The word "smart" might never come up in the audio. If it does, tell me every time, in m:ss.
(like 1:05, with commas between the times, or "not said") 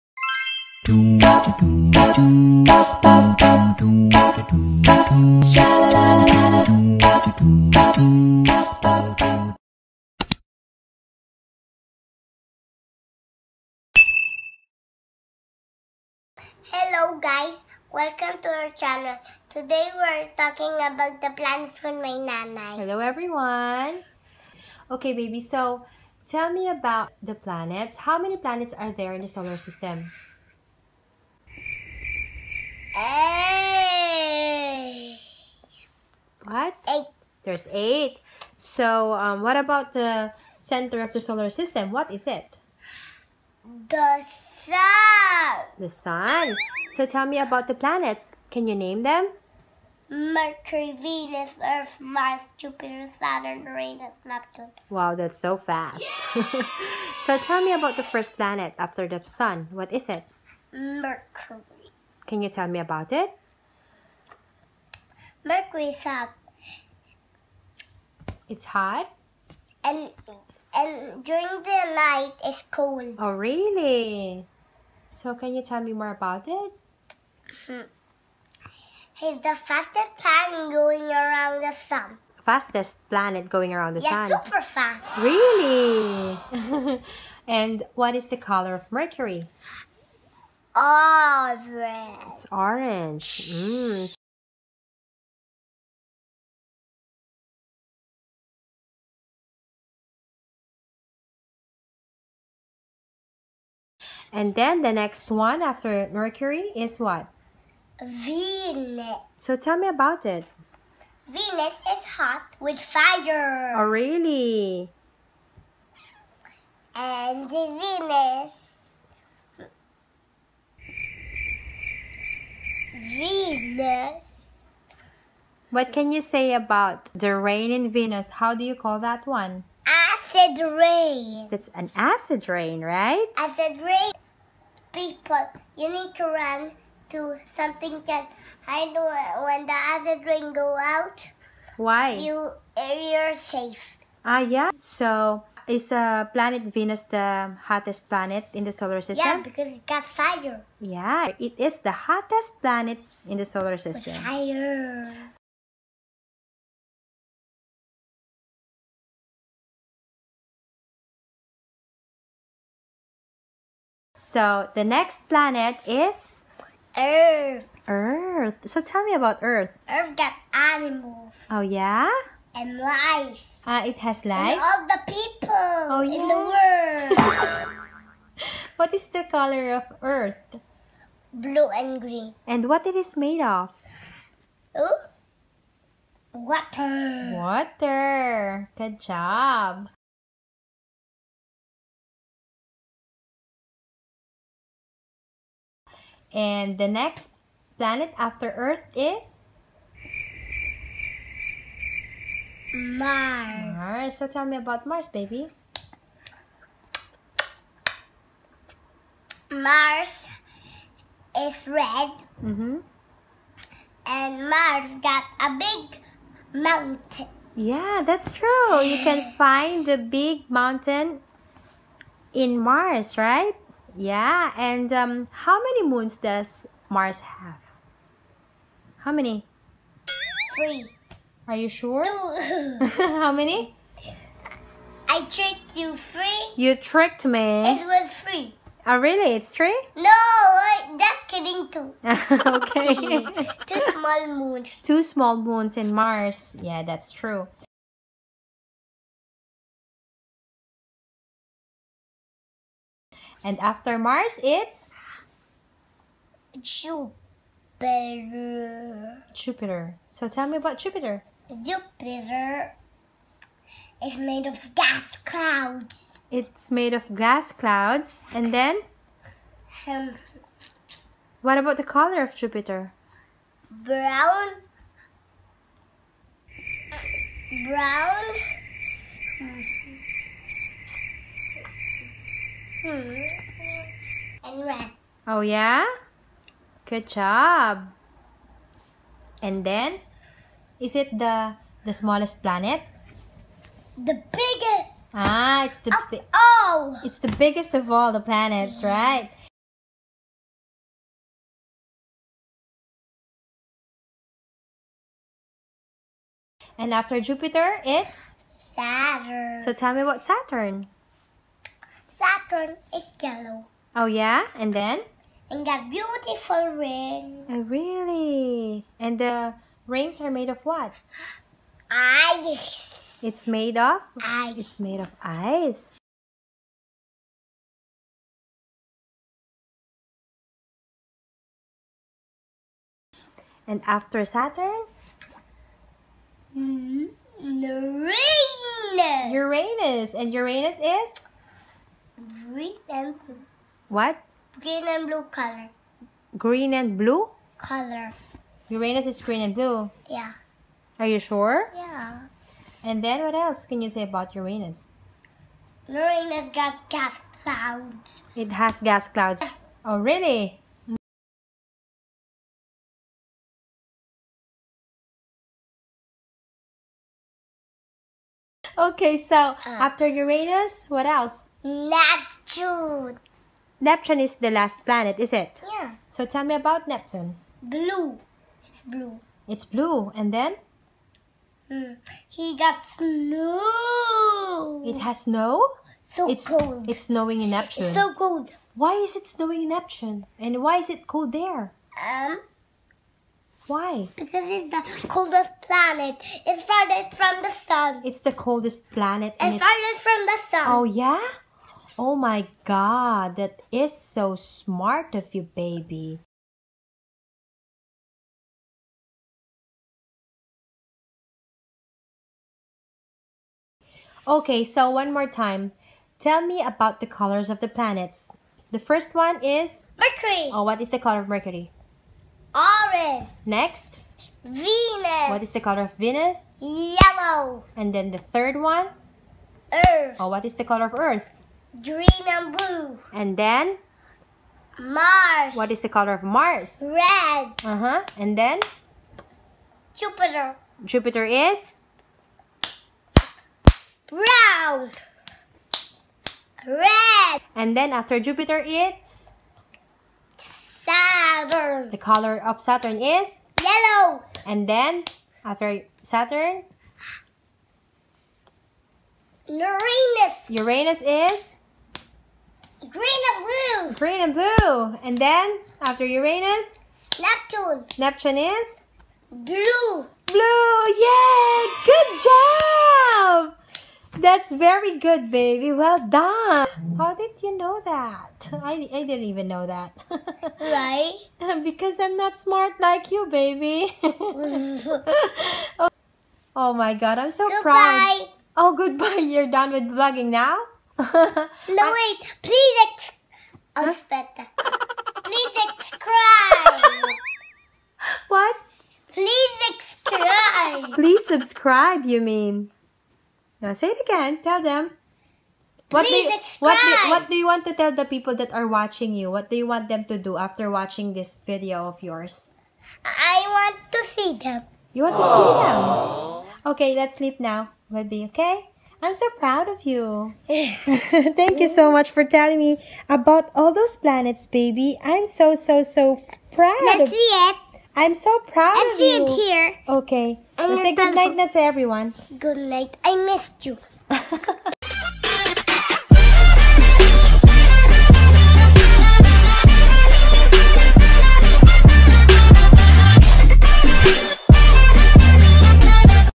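6:44, 8:02.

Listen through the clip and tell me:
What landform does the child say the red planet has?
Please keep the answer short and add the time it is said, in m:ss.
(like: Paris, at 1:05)
A big mountain, at 3:35.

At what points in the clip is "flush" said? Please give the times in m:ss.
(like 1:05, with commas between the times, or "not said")
not said.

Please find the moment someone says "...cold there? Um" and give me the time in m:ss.
6:31.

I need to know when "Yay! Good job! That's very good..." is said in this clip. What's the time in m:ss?
7:51.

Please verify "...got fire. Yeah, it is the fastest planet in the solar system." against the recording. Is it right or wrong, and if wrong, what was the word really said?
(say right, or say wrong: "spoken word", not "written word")
wrong: "hottest", not "fastest".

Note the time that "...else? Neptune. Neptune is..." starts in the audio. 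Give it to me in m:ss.
6:11.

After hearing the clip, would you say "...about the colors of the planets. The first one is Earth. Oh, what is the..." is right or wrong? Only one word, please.
wrong.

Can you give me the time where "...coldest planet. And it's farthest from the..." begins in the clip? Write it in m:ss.
6:38.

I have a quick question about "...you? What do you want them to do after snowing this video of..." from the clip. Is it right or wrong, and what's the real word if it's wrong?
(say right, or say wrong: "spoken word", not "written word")
wrong: "watching", not "snowing".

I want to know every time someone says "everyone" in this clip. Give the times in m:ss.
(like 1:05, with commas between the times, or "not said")
0:22, 8:51.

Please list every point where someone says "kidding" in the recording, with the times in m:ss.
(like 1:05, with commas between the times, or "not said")
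4:01.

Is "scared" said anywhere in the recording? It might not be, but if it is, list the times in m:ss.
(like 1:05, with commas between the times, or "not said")
not said.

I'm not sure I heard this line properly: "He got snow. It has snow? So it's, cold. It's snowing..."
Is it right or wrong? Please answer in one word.
right.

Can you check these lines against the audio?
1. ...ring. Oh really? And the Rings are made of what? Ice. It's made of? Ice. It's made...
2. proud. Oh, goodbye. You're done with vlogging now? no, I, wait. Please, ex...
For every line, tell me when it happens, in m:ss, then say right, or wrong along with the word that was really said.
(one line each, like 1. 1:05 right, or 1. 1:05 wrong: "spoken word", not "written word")
1. 5:16 right
2. 8:07 right.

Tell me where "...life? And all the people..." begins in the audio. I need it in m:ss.
2:54.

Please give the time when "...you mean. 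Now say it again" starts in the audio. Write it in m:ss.
8:22.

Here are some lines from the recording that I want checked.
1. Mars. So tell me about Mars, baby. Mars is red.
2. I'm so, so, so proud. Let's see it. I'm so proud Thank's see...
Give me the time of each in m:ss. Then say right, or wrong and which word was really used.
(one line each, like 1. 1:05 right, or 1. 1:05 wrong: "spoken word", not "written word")
1. 3:23 right
2. 8:45 wrong: "Let", not "Thank".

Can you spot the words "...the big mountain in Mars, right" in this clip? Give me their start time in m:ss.
3:39.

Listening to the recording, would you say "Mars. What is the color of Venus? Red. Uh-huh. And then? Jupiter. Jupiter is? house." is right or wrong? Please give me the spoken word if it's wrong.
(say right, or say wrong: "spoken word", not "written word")
wrong: "Mars", not "Venus".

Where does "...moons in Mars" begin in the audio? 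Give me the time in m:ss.
4:05.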